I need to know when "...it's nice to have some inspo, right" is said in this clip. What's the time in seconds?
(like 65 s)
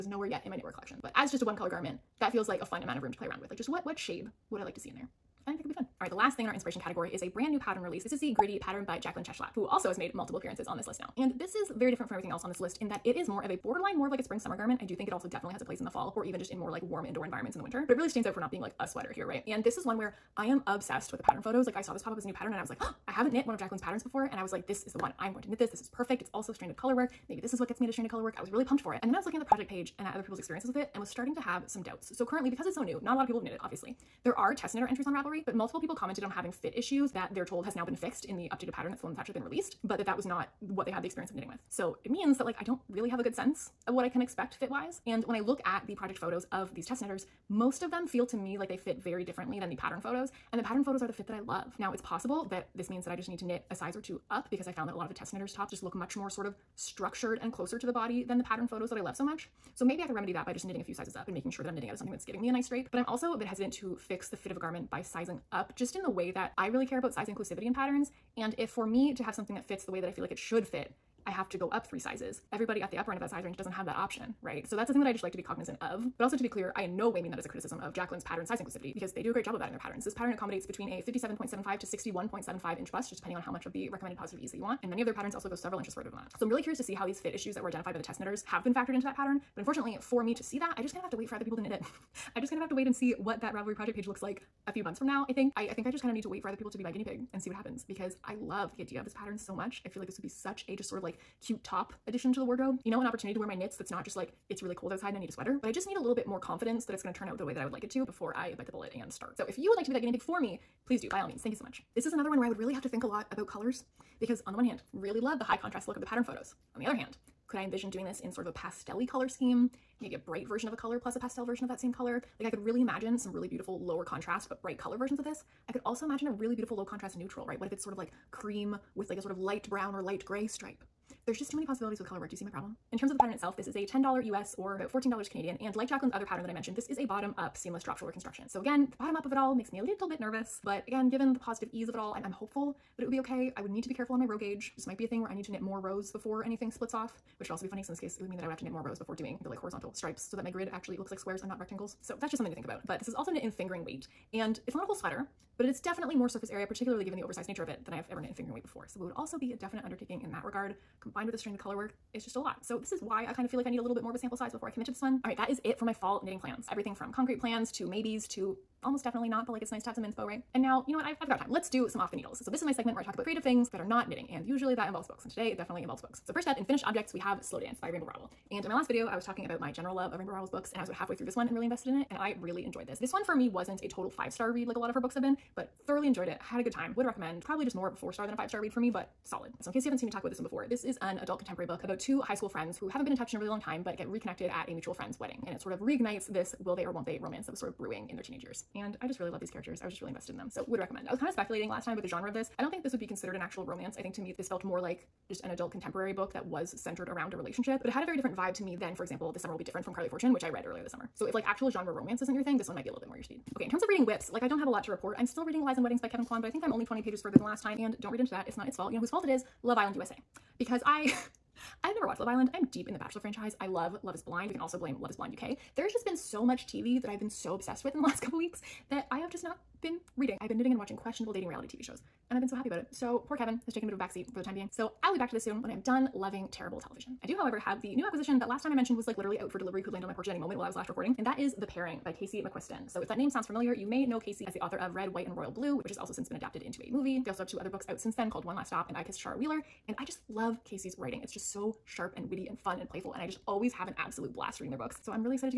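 169 s.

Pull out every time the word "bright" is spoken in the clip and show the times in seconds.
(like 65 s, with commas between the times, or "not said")
120 s, 124 s.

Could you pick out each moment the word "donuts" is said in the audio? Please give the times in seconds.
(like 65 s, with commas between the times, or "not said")
not said.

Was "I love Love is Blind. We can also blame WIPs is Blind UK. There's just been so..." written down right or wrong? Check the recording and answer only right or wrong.
wrong.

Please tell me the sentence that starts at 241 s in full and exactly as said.
And that is The Pairing by Casey McQuiston.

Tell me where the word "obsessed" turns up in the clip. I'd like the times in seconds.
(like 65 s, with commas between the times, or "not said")
20 s, 227 s.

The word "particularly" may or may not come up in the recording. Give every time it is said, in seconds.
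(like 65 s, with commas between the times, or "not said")
156 s.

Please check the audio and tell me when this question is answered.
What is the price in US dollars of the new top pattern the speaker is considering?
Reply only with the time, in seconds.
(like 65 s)
133 s.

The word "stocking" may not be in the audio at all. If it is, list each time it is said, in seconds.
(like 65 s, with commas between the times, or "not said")
not said.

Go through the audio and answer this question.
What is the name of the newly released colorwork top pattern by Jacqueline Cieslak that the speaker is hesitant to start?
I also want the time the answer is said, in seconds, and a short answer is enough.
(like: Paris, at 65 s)
Gritty, at 8 s.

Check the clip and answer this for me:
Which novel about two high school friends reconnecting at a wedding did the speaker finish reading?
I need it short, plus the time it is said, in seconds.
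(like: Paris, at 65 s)
Slow Dance, at 177 s.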